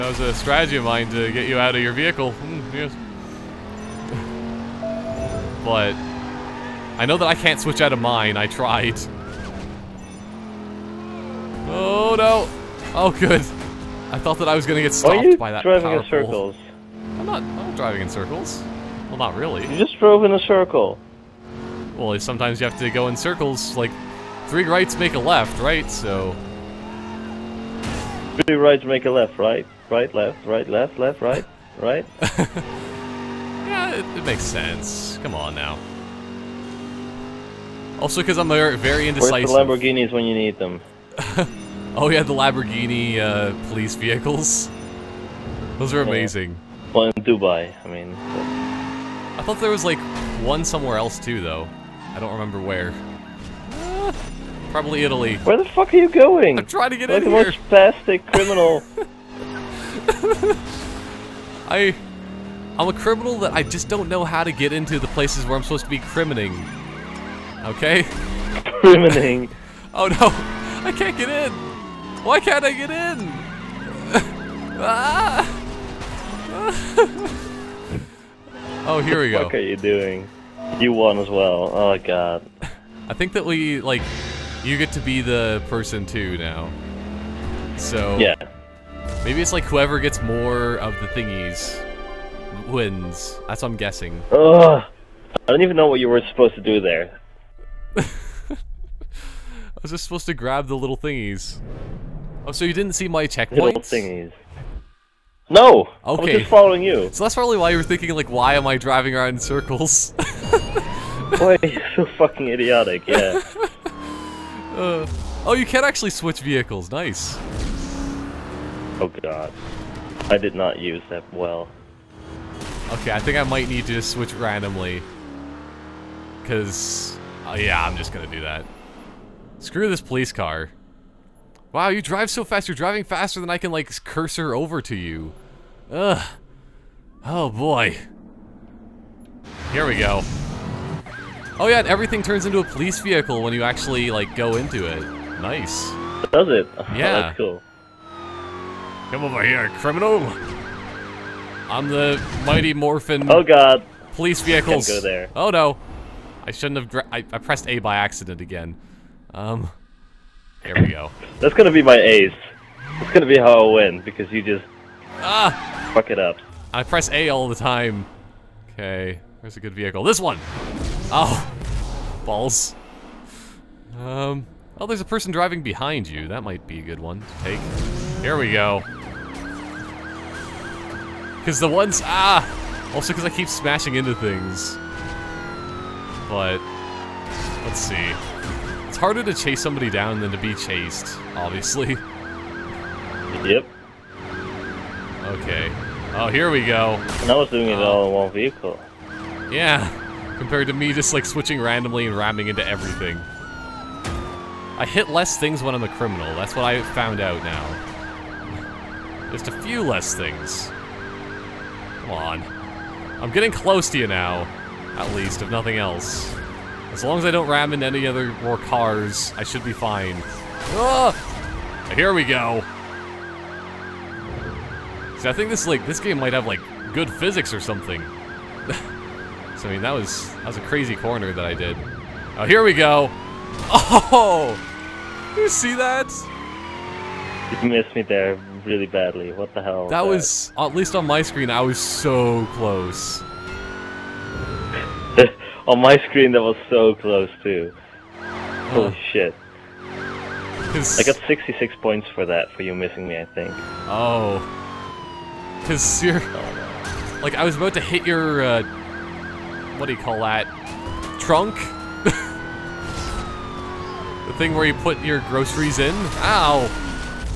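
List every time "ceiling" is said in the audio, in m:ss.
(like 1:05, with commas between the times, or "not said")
not said.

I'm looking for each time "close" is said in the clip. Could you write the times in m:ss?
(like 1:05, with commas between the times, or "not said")
3:33, 4:02, 4:06.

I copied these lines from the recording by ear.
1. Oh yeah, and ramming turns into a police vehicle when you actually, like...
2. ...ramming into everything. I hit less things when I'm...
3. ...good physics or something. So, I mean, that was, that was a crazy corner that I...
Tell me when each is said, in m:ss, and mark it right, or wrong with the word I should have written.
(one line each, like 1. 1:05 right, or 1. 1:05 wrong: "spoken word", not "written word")
1. 2:21 wrong: "everything", not "ramming"
2. 3:22 right
3. 3:46 right.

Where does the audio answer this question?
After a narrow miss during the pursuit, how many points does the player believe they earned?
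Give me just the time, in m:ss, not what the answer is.
4:11.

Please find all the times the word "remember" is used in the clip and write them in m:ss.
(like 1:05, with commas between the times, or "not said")
0:52.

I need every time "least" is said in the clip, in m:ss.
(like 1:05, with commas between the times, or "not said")
3:35, 4:00.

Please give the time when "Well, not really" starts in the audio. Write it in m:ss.
0:19.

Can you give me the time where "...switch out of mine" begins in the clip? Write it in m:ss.
0:07.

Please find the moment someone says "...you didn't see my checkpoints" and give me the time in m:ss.
1:42.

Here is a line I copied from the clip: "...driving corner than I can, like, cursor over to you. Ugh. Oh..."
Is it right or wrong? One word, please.
wrong.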